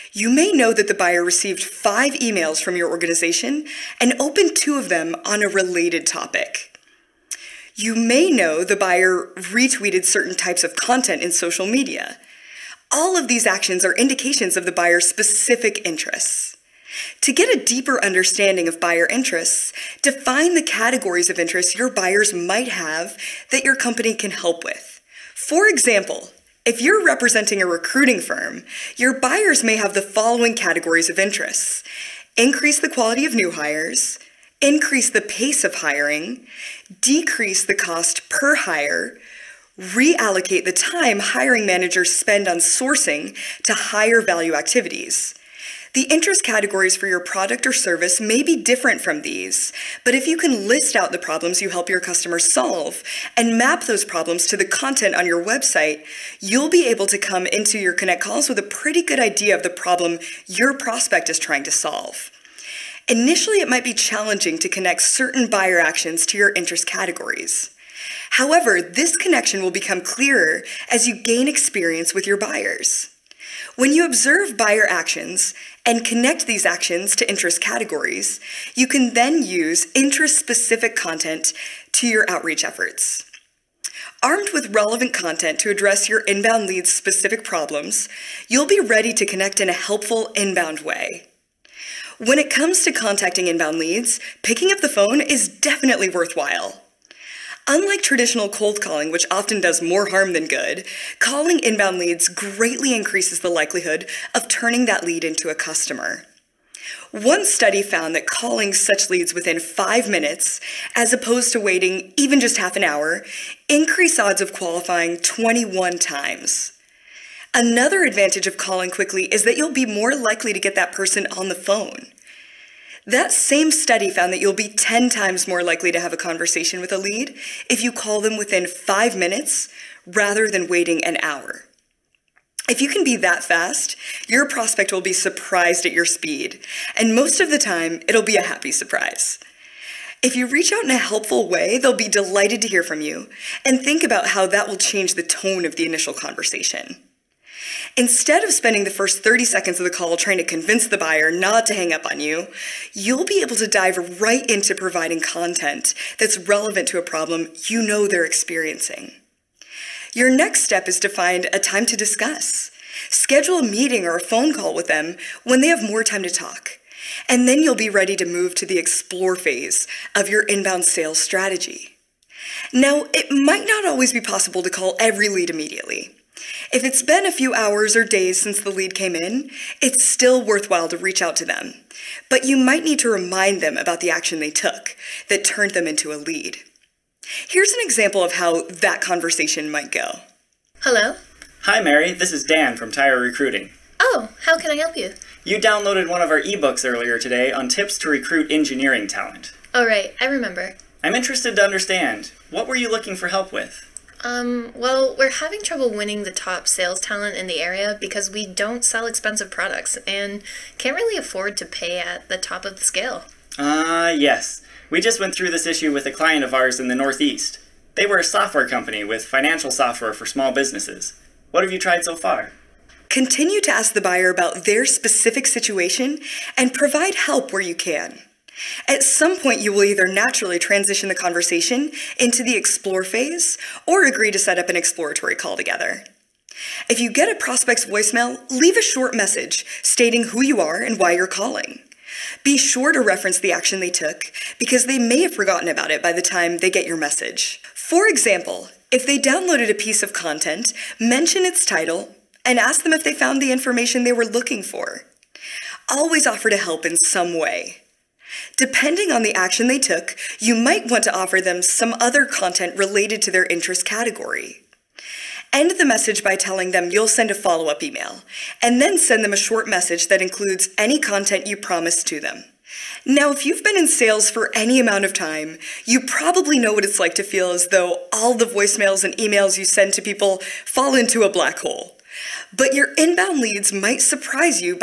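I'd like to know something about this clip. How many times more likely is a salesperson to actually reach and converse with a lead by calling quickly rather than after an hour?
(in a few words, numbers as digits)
10 times.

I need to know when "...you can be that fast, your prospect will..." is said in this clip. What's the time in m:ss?
2:12.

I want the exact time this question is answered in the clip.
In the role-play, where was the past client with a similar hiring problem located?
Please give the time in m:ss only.
3:36.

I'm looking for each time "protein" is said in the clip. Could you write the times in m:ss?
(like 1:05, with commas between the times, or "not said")
not said.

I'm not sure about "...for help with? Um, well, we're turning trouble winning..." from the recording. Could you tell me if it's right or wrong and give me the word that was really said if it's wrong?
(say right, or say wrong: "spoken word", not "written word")
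wrong: "having", not "turning".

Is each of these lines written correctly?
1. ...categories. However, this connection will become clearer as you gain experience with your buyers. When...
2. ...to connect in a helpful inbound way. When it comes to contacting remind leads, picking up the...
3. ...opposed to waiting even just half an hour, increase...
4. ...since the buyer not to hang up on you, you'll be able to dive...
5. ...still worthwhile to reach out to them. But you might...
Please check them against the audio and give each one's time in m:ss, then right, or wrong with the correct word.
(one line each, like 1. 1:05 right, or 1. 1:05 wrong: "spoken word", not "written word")
1. 1:06 right
2. 1:29 wrong: "inbound", not "remind"
3. 1:51 right
4. 2:30 wrong: "convince", not "since"
5. 3:00 right.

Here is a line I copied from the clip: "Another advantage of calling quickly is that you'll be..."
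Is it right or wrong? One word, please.
right.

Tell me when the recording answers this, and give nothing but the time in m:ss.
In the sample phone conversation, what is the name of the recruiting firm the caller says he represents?
3:12.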